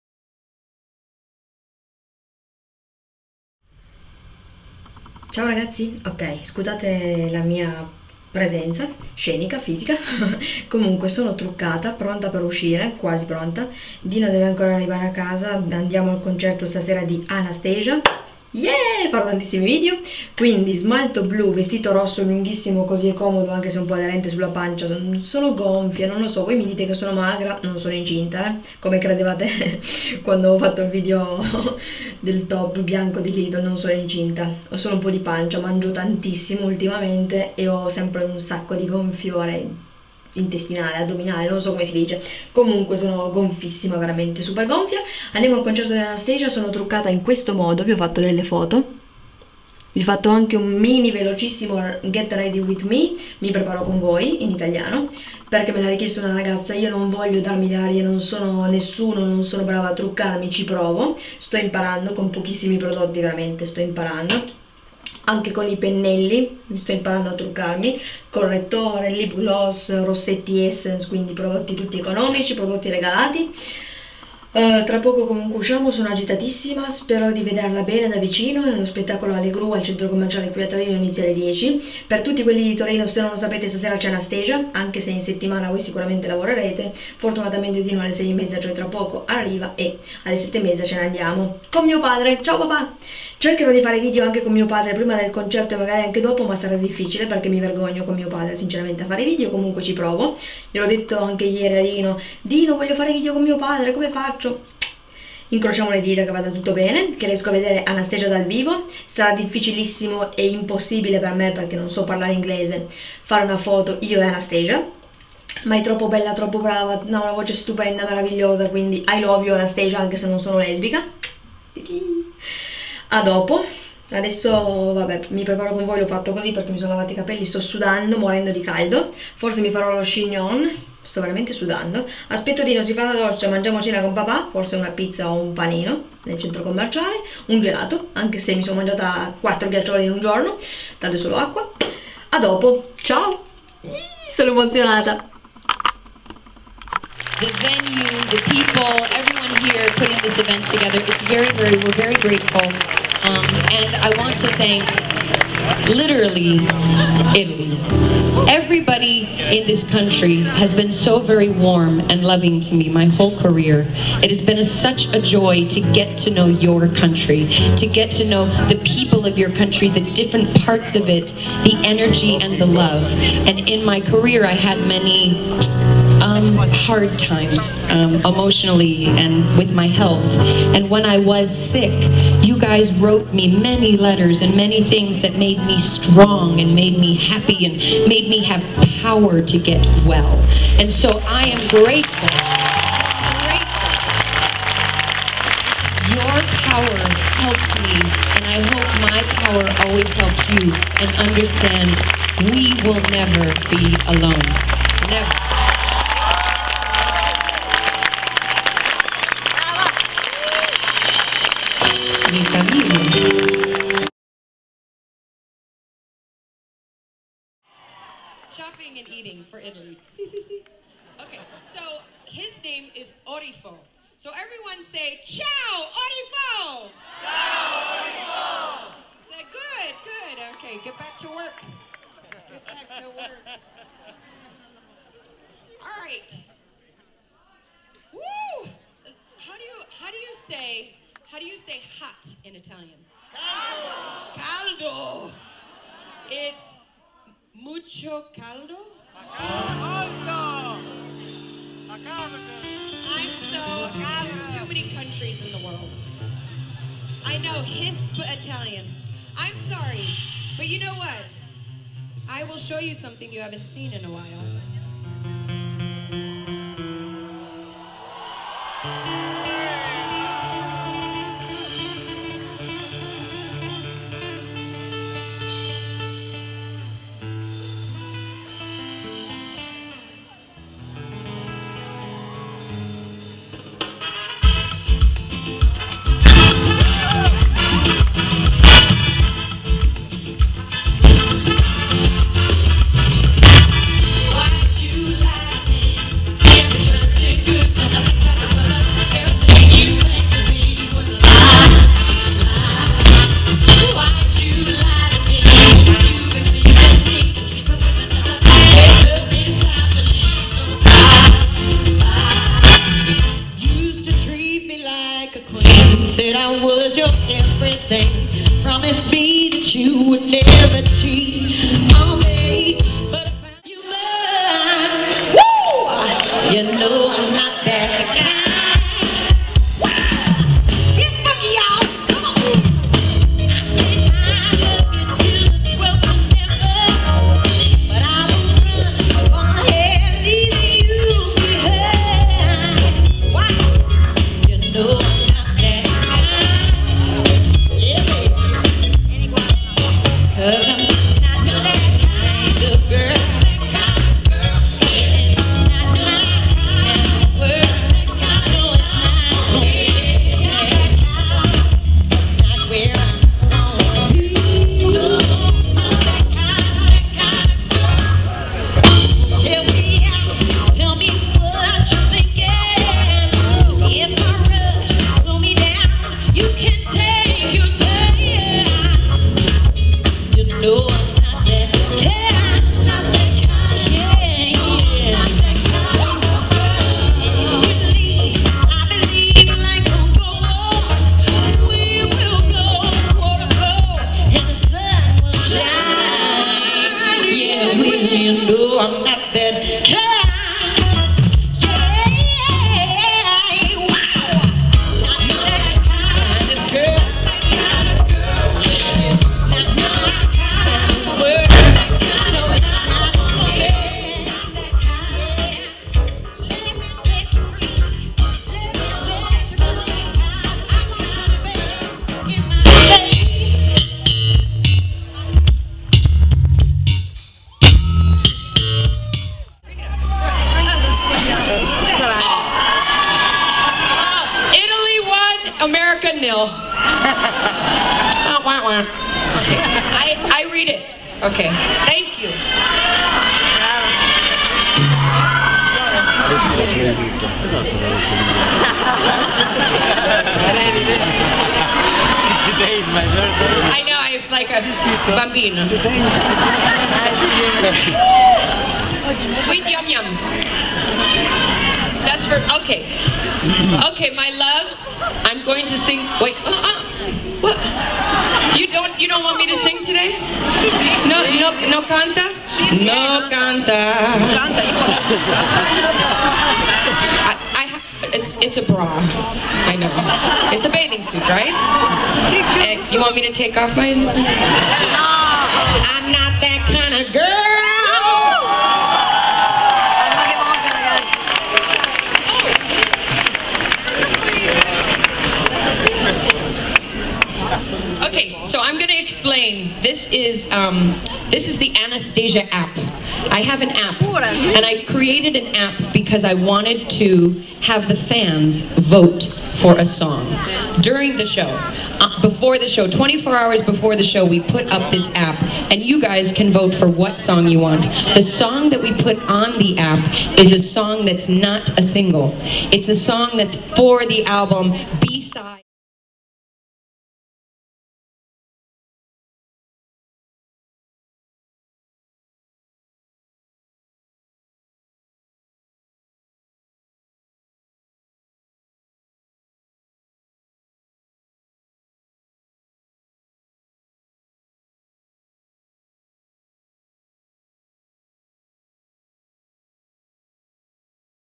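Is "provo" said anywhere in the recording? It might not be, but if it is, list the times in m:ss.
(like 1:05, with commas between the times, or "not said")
1:00, 1:39.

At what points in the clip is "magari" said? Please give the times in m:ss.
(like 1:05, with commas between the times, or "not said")
1:35.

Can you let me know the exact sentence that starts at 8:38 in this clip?
The song that we put on the app is a song that's not a single.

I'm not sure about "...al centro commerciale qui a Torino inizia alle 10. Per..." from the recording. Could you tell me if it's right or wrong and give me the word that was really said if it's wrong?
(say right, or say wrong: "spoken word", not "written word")
right.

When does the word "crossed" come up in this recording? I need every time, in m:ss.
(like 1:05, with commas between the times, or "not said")
not said.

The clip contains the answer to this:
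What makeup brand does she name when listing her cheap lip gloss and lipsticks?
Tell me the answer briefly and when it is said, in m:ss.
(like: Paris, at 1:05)
Essence, at 1:10.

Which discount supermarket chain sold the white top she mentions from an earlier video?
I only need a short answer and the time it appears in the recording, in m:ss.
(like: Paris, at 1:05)
Lidl, at 0:33.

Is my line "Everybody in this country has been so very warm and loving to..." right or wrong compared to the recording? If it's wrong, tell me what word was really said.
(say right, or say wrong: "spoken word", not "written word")
right.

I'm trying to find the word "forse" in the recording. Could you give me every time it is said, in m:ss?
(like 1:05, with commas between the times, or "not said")
2:09, 2:14.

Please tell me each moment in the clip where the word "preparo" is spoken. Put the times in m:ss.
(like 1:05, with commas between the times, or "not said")
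0:53, 2:05.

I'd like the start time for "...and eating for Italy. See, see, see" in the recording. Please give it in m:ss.
3:38.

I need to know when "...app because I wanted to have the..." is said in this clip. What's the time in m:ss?
8:25.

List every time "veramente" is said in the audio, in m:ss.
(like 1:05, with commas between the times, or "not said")
0:43, 1:03, 2:11.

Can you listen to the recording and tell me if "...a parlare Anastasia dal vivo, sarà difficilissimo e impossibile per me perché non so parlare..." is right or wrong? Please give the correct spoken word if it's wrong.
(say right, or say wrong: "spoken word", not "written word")
wrong: "vedere", not "parlare".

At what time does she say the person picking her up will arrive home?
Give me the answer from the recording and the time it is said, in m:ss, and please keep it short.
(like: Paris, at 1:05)
6:30, at 1:28.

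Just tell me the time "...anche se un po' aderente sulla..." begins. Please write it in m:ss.
0:23.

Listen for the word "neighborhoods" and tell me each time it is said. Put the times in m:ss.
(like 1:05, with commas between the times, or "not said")
not said.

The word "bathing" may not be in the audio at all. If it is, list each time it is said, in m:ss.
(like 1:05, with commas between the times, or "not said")
8:00.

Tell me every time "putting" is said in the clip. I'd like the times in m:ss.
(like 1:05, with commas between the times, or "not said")
2:29.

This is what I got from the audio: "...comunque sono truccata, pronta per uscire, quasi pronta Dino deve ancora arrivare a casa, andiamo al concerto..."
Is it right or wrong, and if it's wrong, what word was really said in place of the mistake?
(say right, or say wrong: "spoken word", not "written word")
right.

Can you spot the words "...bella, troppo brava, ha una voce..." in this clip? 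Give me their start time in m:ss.
1:56.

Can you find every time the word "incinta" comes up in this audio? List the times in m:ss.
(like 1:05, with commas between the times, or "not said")
0:27, 0:33.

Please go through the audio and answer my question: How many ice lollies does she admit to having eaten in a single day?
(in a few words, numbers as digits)
4.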